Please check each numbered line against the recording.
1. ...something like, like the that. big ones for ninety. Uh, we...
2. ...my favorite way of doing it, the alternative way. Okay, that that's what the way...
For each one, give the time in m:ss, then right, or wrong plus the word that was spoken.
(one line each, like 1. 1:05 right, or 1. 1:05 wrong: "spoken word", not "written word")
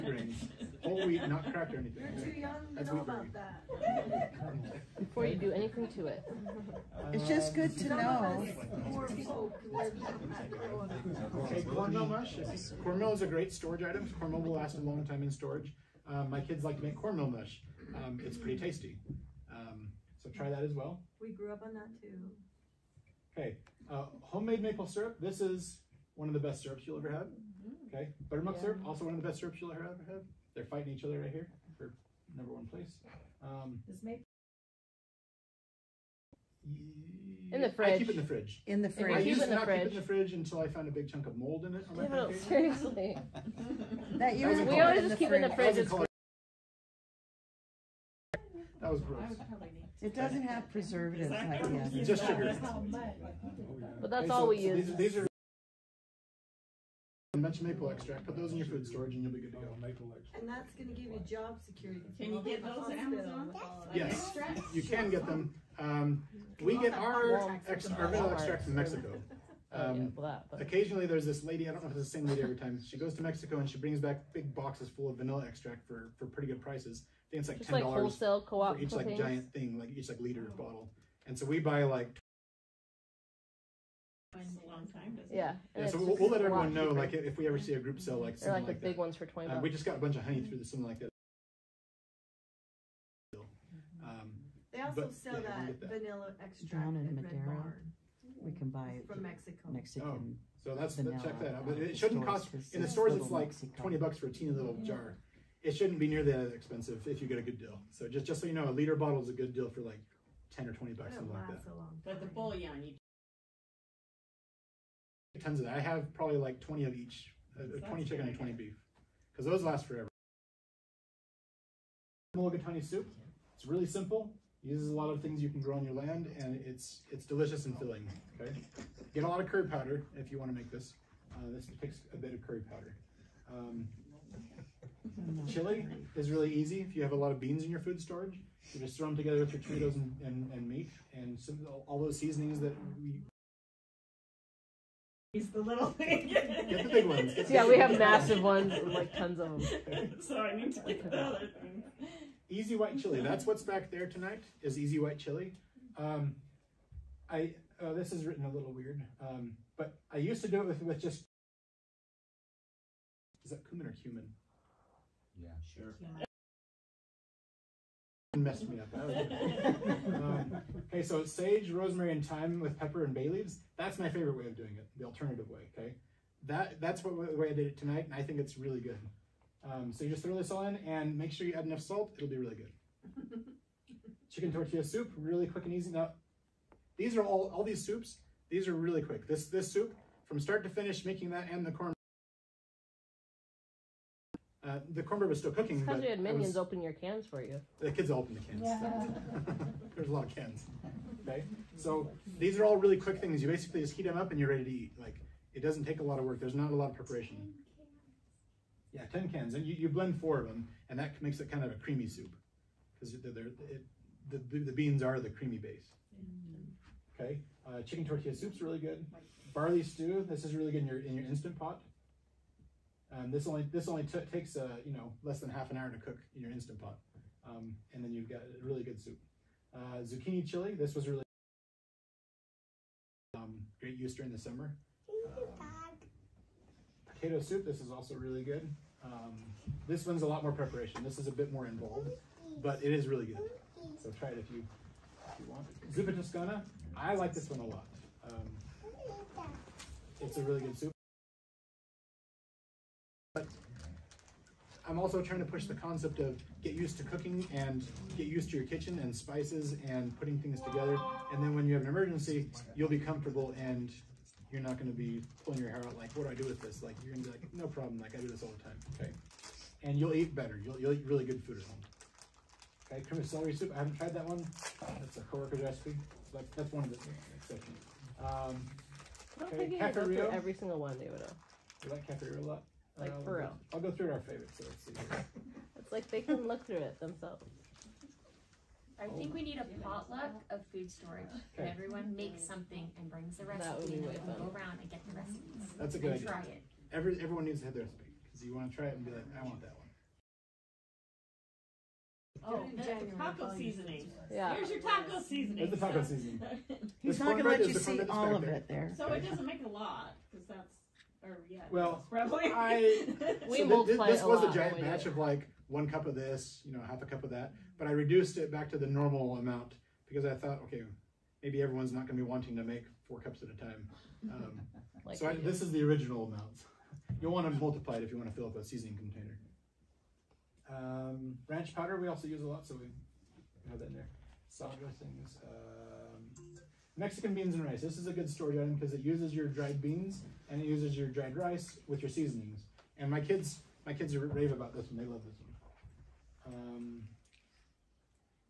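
1. 1:28 wrong: "twenty", not "ninety"
2. 2:53 right.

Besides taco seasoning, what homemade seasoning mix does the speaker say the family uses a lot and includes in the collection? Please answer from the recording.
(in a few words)
ranch powder.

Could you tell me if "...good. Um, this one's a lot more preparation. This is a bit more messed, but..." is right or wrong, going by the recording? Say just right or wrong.
wrong.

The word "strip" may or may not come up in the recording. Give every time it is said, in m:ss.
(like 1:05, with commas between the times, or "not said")
not said.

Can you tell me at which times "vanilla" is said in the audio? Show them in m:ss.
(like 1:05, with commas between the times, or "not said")
1:08, 1:15, 1:35.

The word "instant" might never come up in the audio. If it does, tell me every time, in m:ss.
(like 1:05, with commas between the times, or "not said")
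3:41, 3:46.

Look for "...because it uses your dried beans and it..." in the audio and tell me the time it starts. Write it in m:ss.
5:38.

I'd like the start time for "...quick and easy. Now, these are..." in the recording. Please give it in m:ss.
3:05.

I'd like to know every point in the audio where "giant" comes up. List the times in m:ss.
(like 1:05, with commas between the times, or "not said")
1:19, 5:14.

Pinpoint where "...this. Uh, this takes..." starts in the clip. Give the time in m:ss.
2:10.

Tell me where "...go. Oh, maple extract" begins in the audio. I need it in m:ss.
0:59.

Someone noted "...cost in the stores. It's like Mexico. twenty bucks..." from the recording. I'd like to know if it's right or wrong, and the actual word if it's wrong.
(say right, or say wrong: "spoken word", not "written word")
right.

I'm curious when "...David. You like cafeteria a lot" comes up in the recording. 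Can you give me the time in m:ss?
4:40.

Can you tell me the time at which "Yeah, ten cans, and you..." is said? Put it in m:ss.
3:28.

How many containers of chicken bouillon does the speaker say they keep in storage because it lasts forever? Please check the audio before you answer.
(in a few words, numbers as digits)
20.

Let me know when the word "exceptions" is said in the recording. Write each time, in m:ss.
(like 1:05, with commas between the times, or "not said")
4:37.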